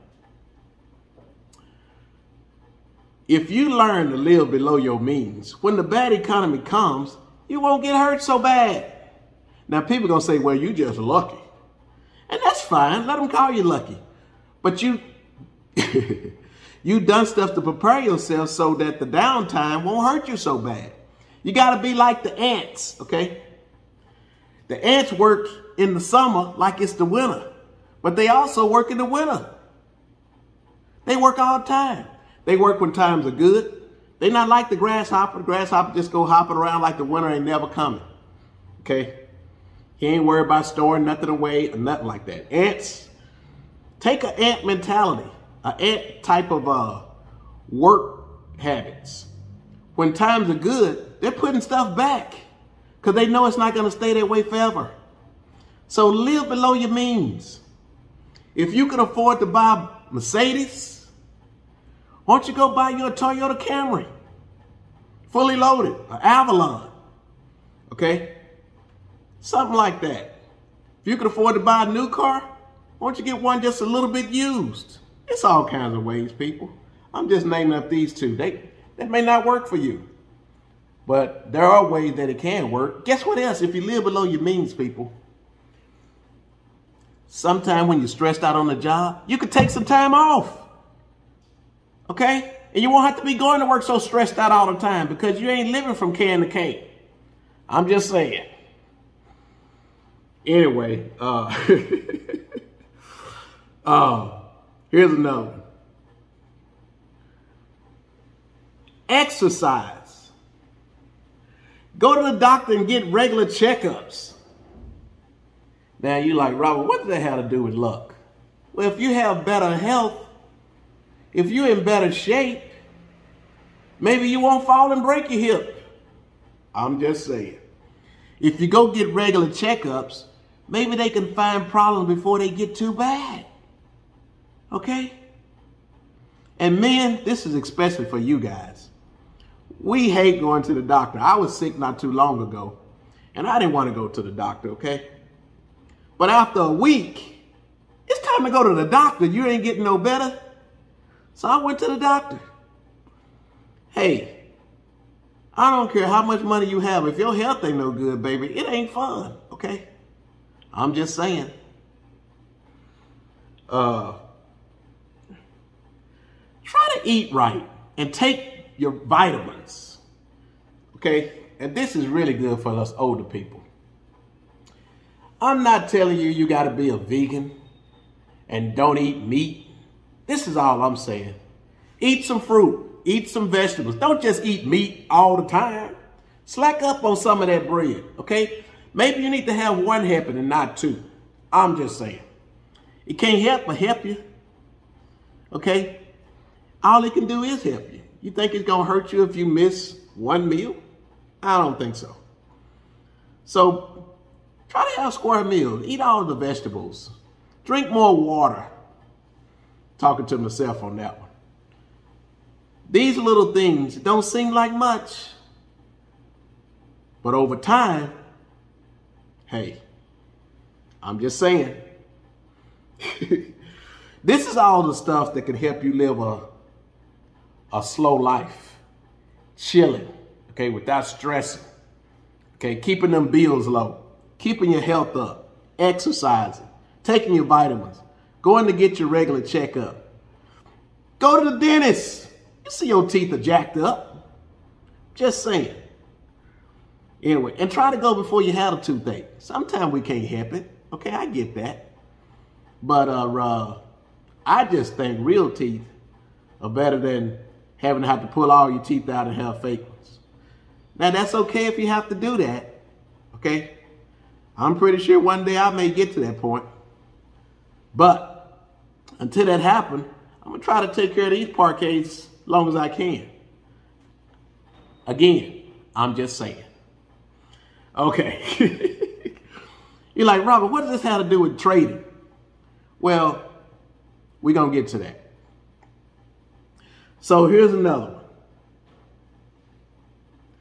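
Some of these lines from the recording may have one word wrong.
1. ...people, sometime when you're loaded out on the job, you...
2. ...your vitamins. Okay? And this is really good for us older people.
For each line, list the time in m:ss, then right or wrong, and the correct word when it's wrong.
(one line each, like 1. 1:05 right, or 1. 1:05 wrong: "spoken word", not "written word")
1. 1:24 wrong: "stressed", not "loaded"
2. 2:48 right.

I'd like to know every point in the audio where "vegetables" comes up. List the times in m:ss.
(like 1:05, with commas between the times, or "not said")
3:03, 3:26.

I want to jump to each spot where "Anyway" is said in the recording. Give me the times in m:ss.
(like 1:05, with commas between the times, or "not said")
1:40, 4:07.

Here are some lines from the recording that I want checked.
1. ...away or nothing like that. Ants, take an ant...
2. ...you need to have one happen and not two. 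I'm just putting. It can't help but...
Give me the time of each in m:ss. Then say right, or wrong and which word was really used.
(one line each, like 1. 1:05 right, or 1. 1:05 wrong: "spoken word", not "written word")
1. 0:41 right
2. 3:09 wrong: "saying", not "putting".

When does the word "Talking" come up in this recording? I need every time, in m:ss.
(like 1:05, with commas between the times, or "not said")
3:29.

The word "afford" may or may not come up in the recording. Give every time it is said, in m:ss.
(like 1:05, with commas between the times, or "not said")
0:58, 1:11.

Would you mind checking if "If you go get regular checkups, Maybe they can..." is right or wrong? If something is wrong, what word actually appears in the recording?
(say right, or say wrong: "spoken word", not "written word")
right.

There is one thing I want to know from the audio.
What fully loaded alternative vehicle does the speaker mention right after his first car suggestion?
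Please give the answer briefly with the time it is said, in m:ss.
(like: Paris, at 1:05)
Avalon, at 1:06.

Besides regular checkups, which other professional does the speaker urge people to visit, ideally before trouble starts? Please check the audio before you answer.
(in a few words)
the dentist.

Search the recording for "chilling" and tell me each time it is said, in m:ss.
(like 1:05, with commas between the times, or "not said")
3:49.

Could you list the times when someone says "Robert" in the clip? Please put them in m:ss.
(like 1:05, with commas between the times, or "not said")
1:56, 4:40.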